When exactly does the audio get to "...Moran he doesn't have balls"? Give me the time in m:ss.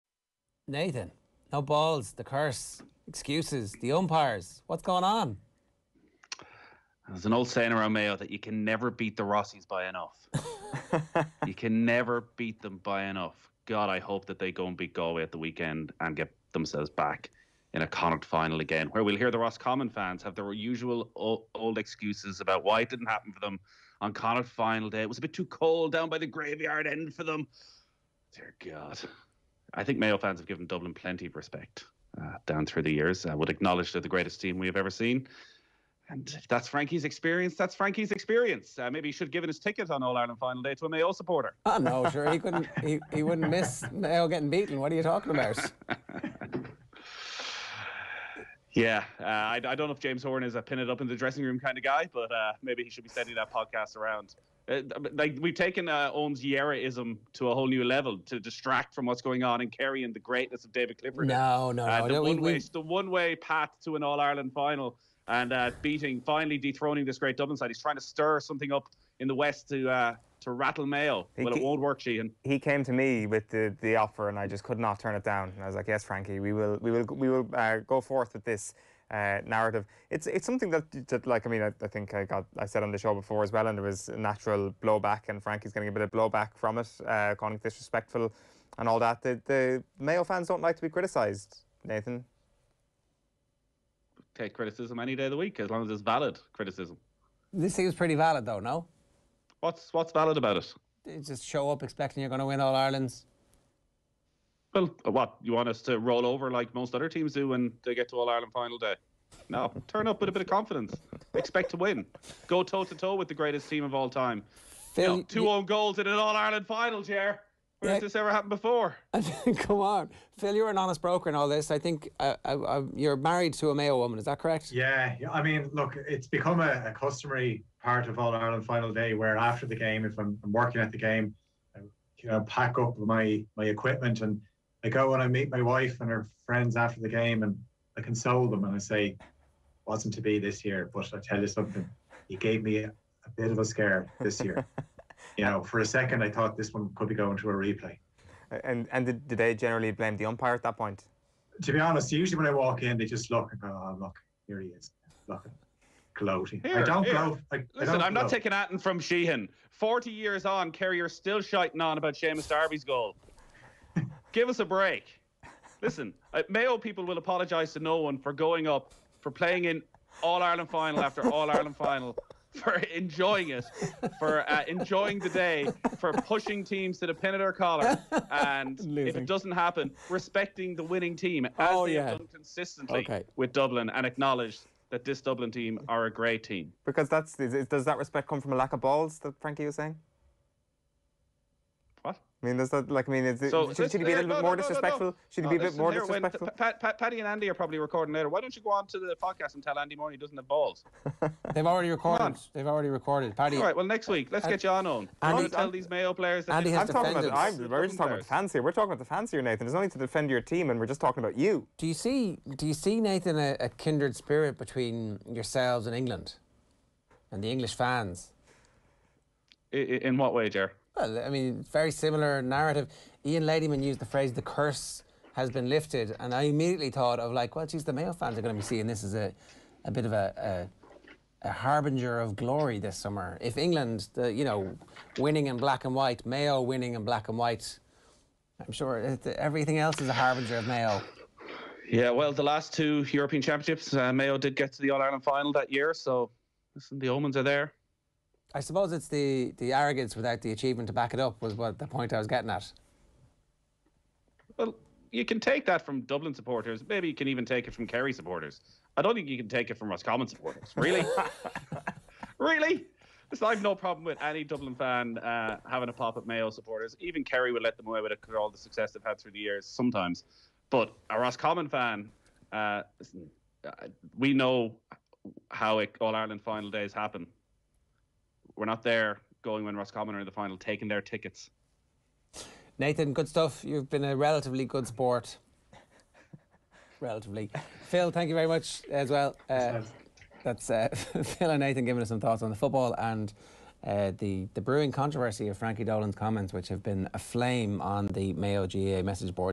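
3:19.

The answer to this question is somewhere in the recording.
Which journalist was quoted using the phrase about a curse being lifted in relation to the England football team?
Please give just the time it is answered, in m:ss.
3:43.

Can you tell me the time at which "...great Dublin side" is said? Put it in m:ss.
1:07.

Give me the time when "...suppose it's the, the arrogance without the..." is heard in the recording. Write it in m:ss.
4:08.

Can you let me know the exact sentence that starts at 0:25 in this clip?
It was a bit too cold down by the graveyard end for them.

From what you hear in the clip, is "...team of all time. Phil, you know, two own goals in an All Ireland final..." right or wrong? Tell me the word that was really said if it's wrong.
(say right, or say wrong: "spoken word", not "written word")
right.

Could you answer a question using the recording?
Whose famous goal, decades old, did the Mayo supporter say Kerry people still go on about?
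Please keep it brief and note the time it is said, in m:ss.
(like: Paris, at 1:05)
Seamus Darby, at 2:42.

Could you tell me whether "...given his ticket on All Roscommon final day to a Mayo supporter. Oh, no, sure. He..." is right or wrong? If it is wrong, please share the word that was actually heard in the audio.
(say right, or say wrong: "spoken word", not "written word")
wrong: "Ireland", not "Roscommon".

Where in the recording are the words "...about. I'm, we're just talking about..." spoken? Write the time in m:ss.
3:27.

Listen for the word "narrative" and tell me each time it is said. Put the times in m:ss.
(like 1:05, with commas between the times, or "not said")
1:19, 3:42.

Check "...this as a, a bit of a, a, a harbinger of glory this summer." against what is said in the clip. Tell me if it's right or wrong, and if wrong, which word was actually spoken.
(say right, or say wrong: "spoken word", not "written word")
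right.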